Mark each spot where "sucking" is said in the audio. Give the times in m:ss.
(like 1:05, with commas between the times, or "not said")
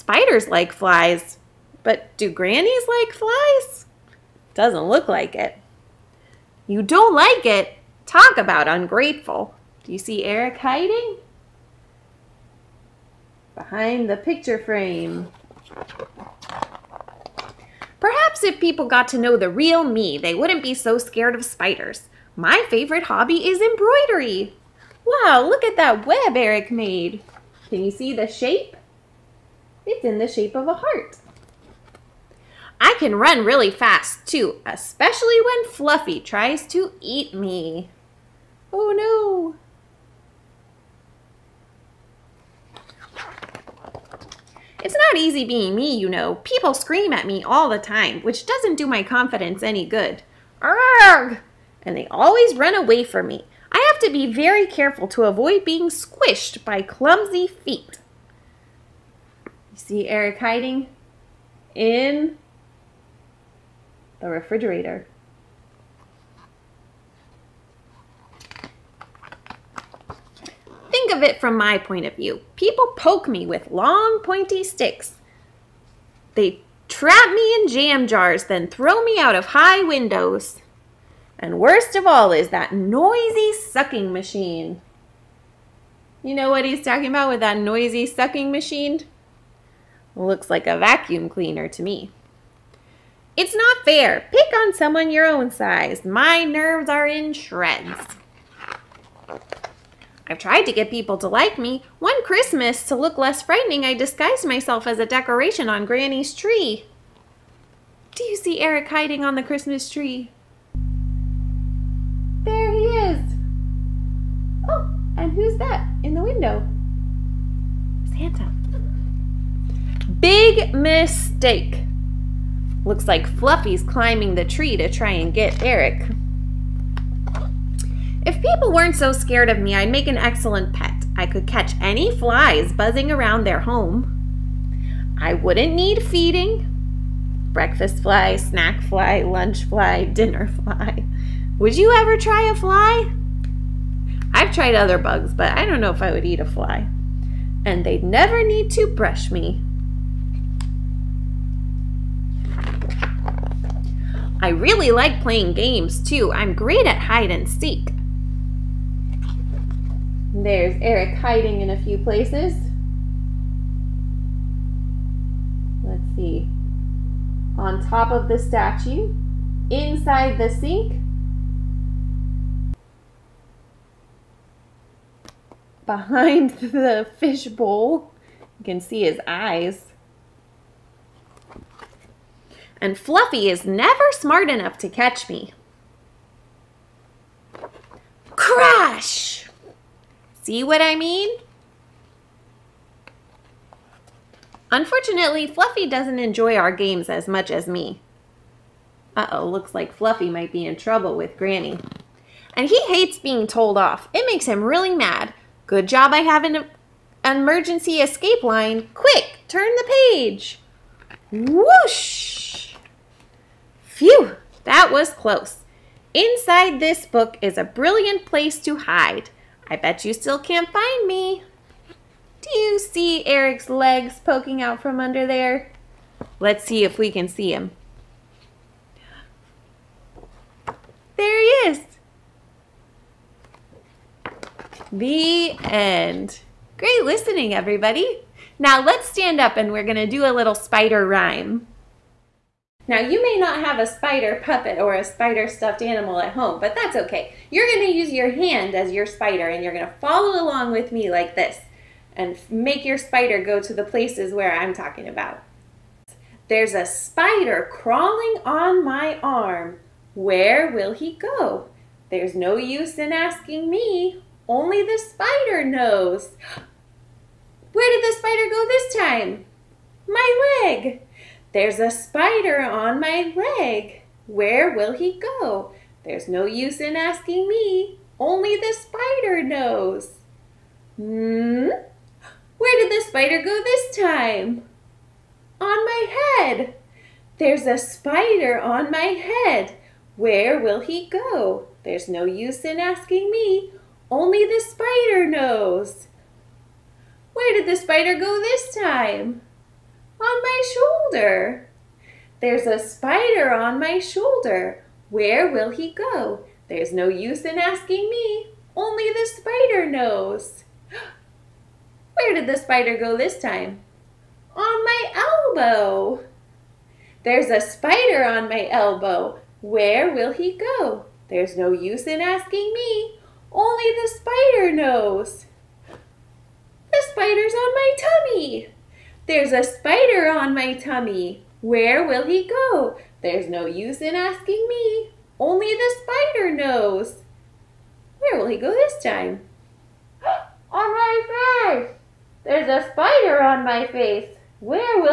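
1:23, 1:28.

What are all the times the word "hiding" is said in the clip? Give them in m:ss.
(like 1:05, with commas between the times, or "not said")
0:10, 1:00, 1:48, 2:41.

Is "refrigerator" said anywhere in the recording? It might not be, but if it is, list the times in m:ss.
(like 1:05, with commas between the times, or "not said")
1:04.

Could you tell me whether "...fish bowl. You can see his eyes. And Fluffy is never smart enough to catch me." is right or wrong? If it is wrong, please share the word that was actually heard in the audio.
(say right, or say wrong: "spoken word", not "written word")
right.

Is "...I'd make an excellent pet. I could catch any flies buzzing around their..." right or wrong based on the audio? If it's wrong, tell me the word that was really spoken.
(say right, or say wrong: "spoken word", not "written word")
right.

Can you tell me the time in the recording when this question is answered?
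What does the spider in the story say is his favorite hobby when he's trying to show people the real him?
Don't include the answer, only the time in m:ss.
0:23.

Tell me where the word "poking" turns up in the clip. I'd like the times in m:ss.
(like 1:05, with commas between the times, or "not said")
3:44.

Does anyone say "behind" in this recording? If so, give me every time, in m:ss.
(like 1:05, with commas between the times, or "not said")
0:13, 2:55.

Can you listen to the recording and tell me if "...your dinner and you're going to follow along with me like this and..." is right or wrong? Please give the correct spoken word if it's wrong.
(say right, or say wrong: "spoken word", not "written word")
wrong: "spider", not "dinner".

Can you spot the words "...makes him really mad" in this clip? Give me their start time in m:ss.
3:24.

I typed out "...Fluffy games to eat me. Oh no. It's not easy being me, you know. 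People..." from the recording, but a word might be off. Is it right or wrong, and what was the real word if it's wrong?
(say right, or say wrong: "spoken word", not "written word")
wrong: "tries", not "games".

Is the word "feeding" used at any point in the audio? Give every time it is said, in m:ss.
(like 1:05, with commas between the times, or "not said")
2:16.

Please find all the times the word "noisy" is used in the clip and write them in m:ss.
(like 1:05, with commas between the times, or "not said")
1:22, 1:27.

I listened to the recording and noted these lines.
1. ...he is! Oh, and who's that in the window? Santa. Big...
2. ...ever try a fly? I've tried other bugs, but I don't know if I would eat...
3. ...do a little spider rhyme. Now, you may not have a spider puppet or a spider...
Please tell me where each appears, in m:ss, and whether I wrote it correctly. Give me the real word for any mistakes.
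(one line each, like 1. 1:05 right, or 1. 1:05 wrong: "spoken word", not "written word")
1. 1:52 right
2. 2:22 right
3. 4:00 right.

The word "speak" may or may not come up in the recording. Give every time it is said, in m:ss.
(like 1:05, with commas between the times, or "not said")
not said.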